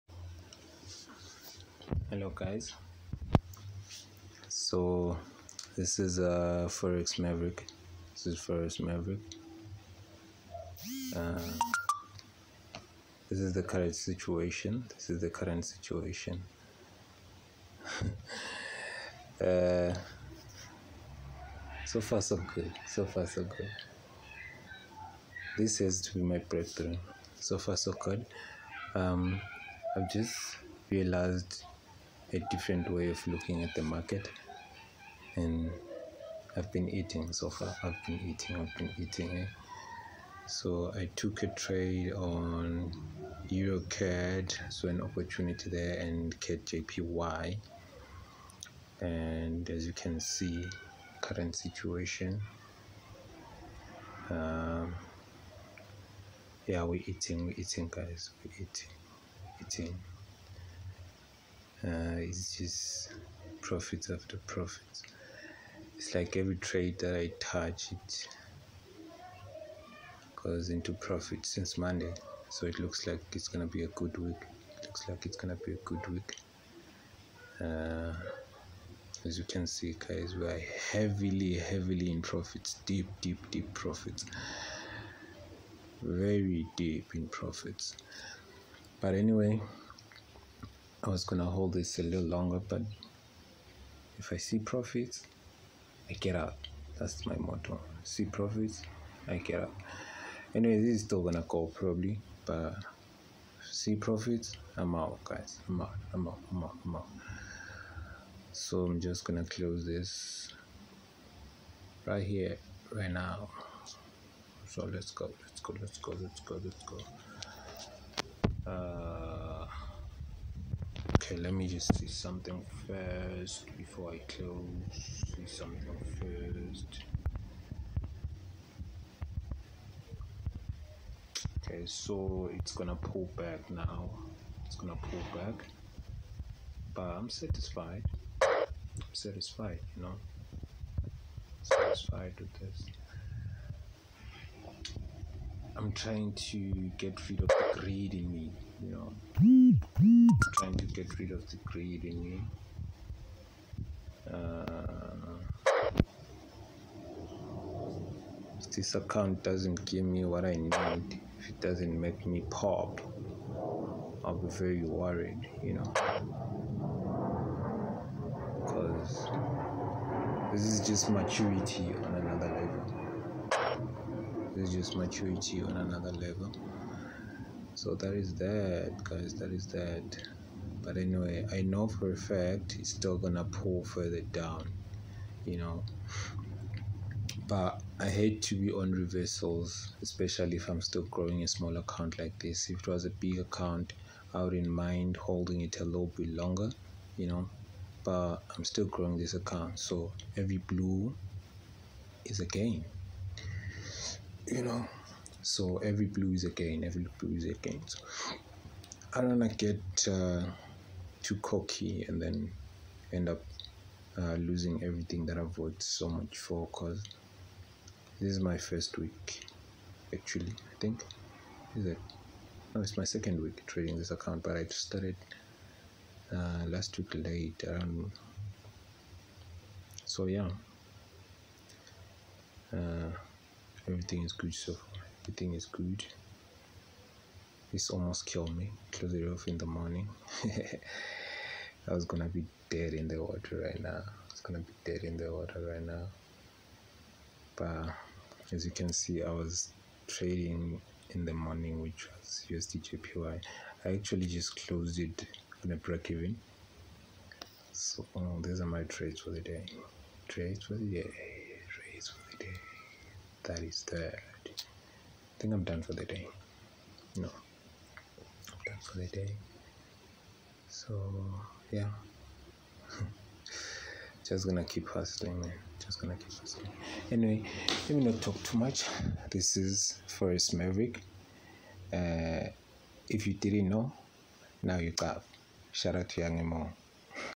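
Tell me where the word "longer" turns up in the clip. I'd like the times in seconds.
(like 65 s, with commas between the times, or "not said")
92 s, 196 s.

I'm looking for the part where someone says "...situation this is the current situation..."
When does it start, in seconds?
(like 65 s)
13 s.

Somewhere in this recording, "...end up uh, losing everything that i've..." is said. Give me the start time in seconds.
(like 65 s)
213 s.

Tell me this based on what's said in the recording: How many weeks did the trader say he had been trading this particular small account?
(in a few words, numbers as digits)
2.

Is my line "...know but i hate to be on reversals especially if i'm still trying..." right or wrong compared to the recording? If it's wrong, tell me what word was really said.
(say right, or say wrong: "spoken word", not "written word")
wrong: "growing", not "trying".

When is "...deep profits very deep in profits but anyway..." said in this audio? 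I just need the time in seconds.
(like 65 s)
83 s.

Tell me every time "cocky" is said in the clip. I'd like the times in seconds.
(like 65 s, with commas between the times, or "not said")
211 s.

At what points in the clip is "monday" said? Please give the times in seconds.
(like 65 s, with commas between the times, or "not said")
71 s.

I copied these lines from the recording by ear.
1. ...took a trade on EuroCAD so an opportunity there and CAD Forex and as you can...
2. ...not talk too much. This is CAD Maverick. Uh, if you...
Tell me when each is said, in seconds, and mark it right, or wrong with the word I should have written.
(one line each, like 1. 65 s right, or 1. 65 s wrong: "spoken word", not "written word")
1. 41 s wrong: "JPY", not "Forex"
2. 278 s wrong: "Forex", not "CAD".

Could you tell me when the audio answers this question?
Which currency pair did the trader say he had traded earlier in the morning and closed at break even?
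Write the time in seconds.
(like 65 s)
252 s.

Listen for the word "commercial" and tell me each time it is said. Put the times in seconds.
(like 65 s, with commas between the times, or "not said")
not said.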